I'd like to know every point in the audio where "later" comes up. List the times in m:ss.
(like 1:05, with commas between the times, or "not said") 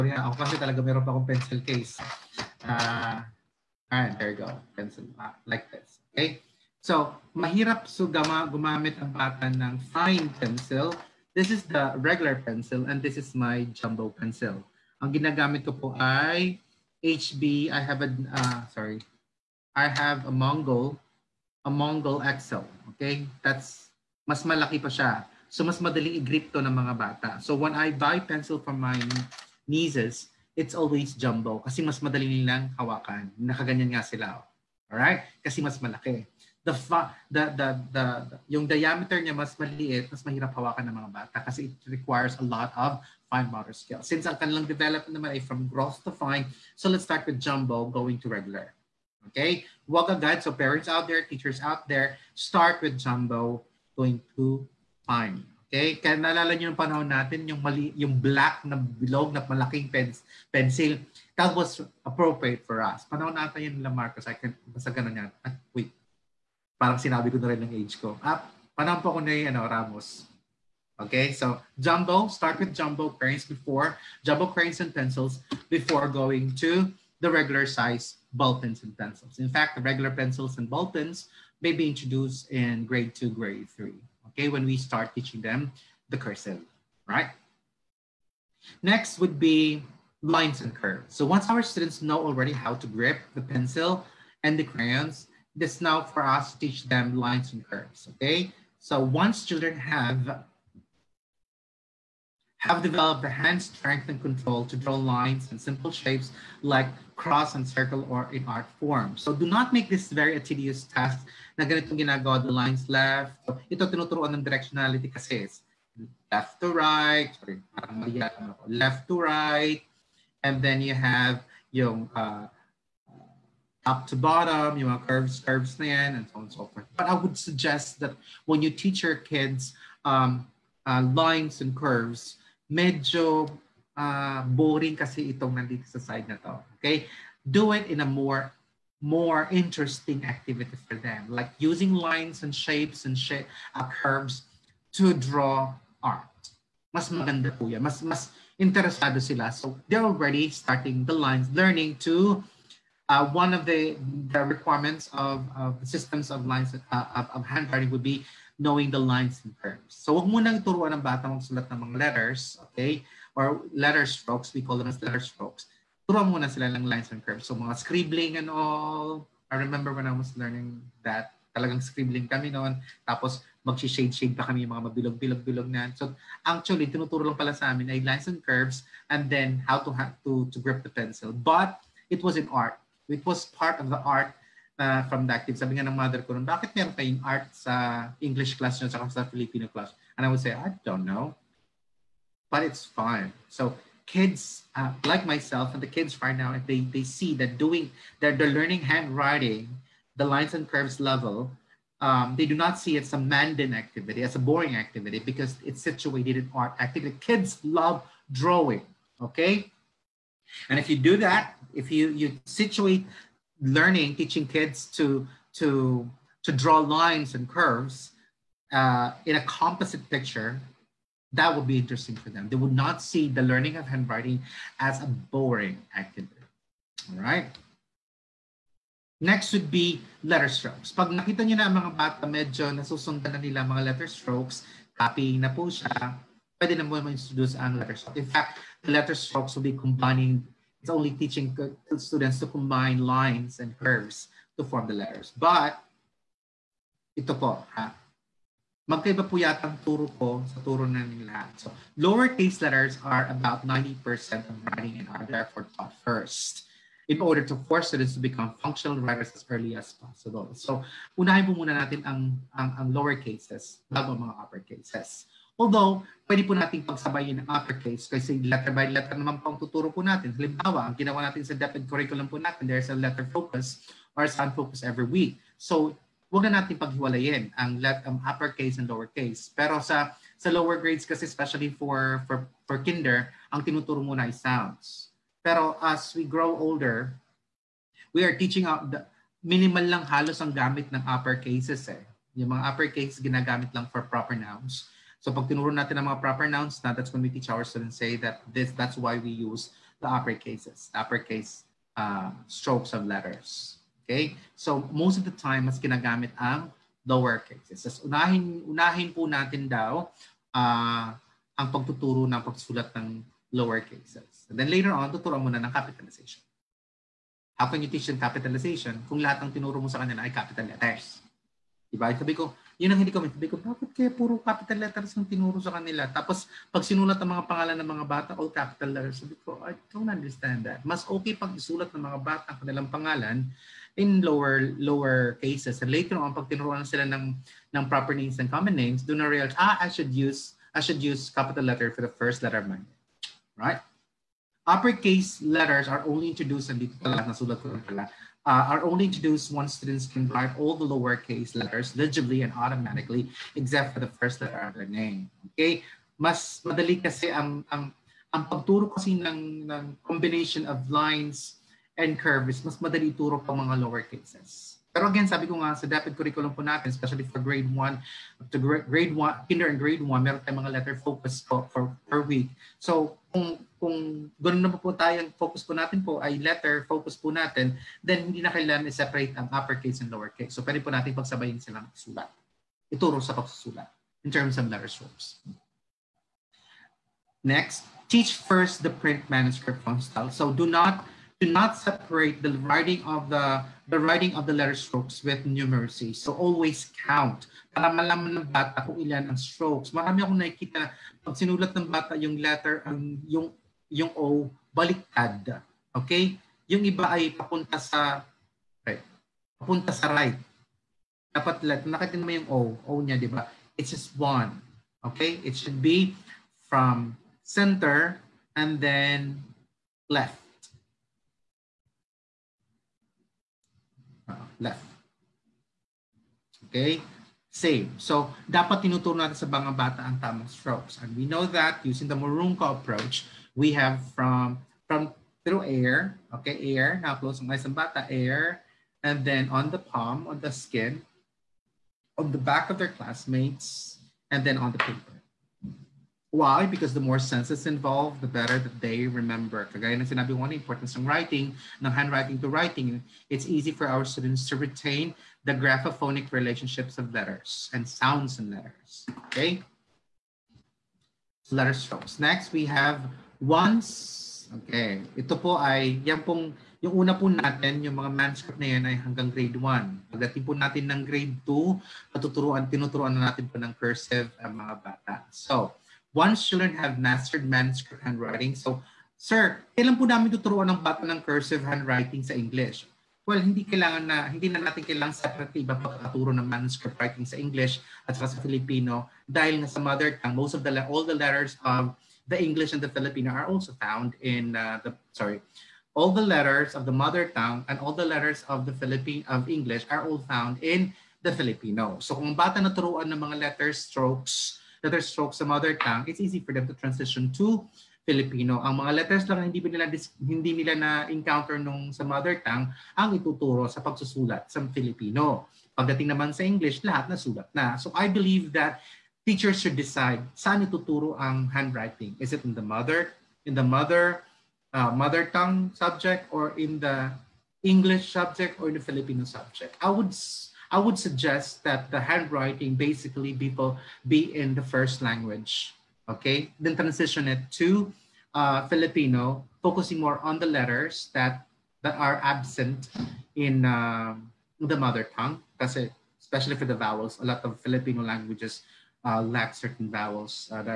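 5:14, 5:35.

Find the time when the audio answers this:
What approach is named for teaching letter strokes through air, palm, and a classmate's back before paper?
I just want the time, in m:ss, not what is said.
7:12.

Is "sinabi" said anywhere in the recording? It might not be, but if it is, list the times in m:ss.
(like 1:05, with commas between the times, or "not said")
1:07, 7:30.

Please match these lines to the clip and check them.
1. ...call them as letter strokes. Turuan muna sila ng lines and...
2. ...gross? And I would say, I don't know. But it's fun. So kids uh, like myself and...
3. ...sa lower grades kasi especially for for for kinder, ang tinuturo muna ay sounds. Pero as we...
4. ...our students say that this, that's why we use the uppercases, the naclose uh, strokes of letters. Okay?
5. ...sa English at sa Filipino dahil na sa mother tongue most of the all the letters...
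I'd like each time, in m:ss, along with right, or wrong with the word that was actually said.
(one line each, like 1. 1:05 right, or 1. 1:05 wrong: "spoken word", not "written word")
1. 2:44 right
2. 3:09 wrong: "class", not "gross"
3. 4:40 right
4. 4:57 wrong: "uppercase", not "naclose"
5. 8:07 right.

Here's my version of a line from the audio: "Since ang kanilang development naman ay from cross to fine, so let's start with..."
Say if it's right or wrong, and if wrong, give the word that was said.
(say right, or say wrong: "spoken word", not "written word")
wrong: "gross", not "cross".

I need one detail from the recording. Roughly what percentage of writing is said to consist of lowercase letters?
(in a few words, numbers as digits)
90%.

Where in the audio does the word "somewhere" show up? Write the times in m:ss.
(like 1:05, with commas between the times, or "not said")
not said.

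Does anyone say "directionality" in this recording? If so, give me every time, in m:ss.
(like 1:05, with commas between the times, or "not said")
1:54.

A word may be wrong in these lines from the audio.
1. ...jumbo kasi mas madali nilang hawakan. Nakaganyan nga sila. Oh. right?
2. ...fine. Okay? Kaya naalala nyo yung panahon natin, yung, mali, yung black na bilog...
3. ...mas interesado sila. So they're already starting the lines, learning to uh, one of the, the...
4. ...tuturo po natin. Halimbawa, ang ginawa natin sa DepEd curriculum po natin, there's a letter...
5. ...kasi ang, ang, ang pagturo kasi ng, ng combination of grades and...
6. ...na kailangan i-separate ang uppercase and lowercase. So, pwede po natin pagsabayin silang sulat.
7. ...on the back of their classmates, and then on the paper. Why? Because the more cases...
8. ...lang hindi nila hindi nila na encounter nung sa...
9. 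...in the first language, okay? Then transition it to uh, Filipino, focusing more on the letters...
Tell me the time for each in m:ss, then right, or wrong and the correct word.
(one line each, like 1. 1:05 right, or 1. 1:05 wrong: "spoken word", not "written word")
1. 0:31 right
2. 0:55 right
3. 2:27 right
4. 4:29 right
5. 5:57 wrong: "lines", not "grades"
6. 6:18 right
7. 7:22 wrong: "senses", not "cases"
8. 8:29 right
9. 8:54 right.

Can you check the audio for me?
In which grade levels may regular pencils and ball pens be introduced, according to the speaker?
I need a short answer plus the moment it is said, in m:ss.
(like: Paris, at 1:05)
Grade 2 or 3, at 1:22.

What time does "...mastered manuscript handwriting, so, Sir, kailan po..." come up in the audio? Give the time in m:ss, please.
7:57.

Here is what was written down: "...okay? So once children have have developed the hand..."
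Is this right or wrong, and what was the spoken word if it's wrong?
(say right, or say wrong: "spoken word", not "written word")
right.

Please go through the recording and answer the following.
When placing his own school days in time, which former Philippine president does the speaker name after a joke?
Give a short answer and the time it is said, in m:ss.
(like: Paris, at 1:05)
Ramos, at 1:09.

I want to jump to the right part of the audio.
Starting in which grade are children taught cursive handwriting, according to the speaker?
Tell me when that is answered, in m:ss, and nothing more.
7:51.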